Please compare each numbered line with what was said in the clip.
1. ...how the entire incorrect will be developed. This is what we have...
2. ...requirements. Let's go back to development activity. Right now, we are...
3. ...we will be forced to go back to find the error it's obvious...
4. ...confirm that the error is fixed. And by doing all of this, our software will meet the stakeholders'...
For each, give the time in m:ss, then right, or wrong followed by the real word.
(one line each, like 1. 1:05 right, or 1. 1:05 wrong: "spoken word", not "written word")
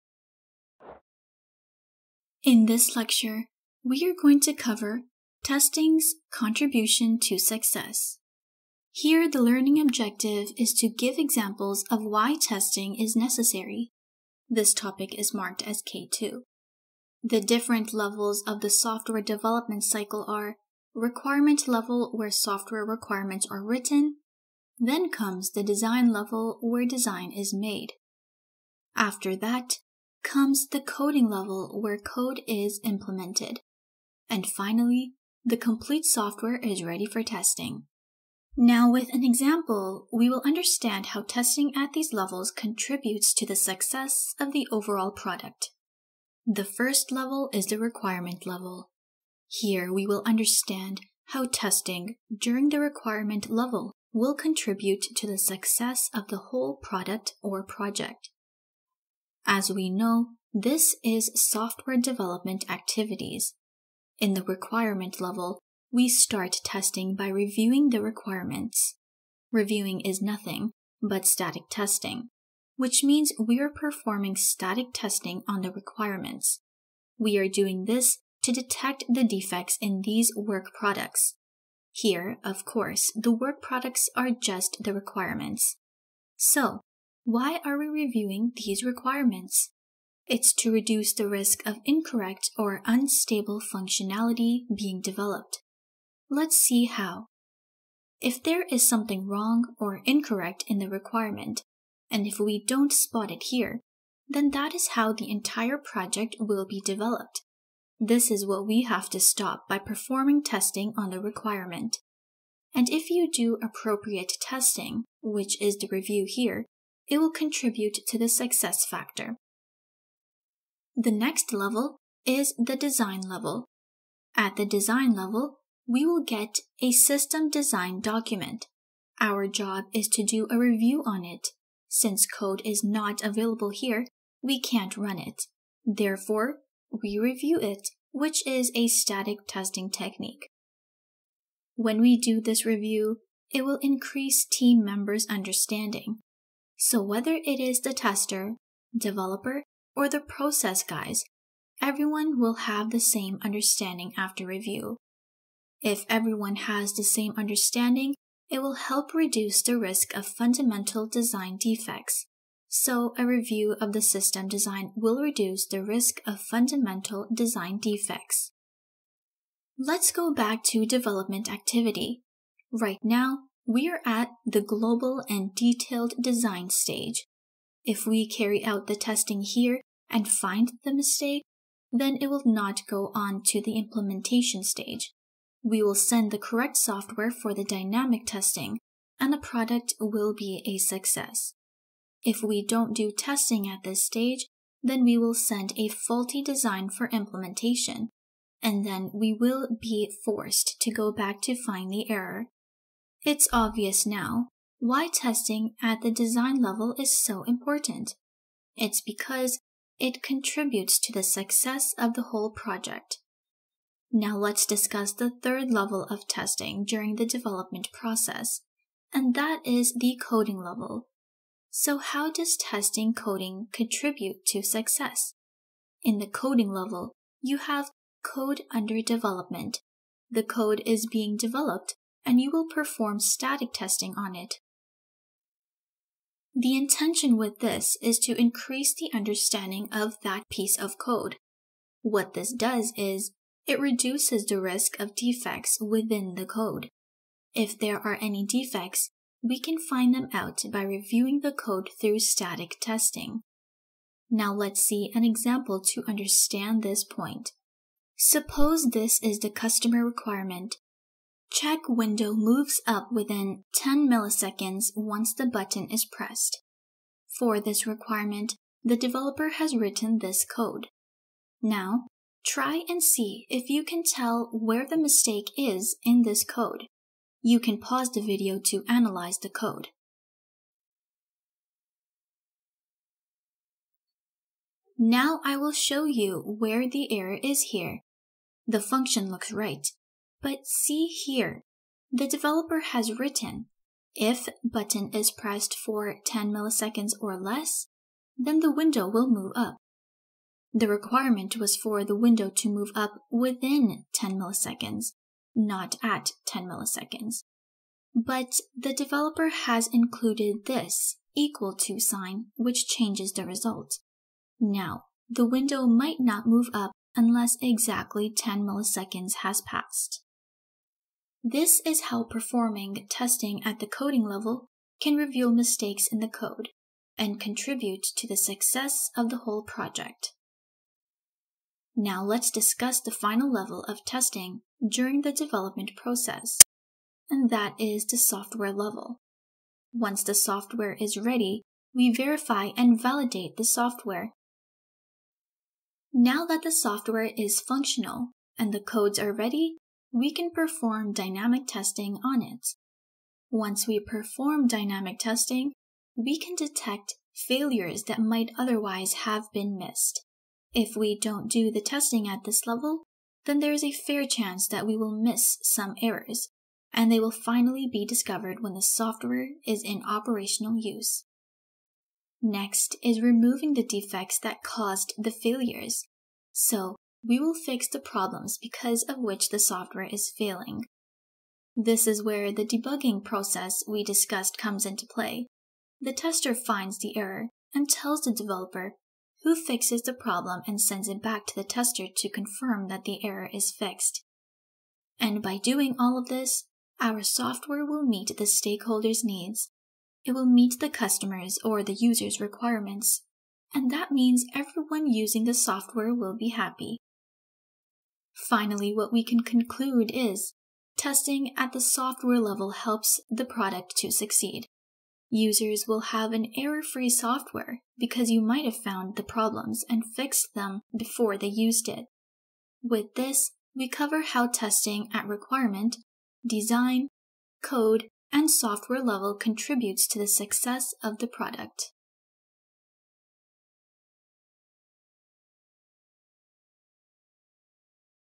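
1. 1:44 wrong: "project", not "incorrect"
2. 2:47 wrong: "defects", not "requirements"
3. 3:19 right
4. 6:32 right.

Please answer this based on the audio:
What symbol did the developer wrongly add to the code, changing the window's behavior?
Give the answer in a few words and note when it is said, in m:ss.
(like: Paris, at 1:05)
equal to sign, at 5:11.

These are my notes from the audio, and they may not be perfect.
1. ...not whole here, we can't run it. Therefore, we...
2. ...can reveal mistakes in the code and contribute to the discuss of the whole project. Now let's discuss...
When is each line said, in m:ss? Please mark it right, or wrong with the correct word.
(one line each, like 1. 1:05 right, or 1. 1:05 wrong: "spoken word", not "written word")
1. 2:12 wrong: "available", not "whole"
2. 5:25 wrong: "success", not "discuss".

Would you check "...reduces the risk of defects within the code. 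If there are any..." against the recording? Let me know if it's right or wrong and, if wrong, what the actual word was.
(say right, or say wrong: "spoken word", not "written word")
right.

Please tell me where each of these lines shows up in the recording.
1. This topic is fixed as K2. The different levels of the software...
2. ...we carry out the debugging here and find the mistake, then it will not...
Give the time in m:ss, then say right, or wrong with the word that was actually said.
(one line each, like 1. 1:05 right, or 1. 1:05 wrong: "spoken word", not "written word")
1. 0:14 wrong: "marked", not "fixed"
2. 2:58 wrong: "testing", not "debugging".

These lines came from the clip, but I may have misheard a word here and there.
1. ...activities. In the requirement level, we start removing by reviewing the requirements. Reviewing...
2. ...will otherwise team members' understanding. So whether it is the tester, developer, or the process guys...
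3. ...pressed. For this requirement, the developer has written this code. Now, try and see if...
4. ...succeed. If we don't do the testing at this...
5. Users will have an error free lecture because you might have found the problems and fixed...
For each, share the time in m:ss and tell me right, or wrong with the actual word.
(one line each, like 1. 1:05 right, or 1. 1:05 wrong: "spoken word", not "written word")
1. 1:02 wrong: "testing", not "removing"
2. 2:23 wrong: "increase", not "otherwise"
3. 4:26 right
4. 5:59 wrong: "missed", not "succeed"
5. 6:55 wrong: "software", not "lecture".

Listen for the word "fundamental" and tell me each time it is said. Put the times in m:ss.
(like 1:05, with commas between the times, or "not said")
2:40, 2:46.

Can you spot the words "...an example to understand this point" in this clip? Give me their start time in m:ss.
4:15.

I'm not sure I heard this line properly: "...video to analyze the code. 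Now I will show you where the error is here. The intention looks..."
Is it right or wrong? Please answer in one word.
wrong.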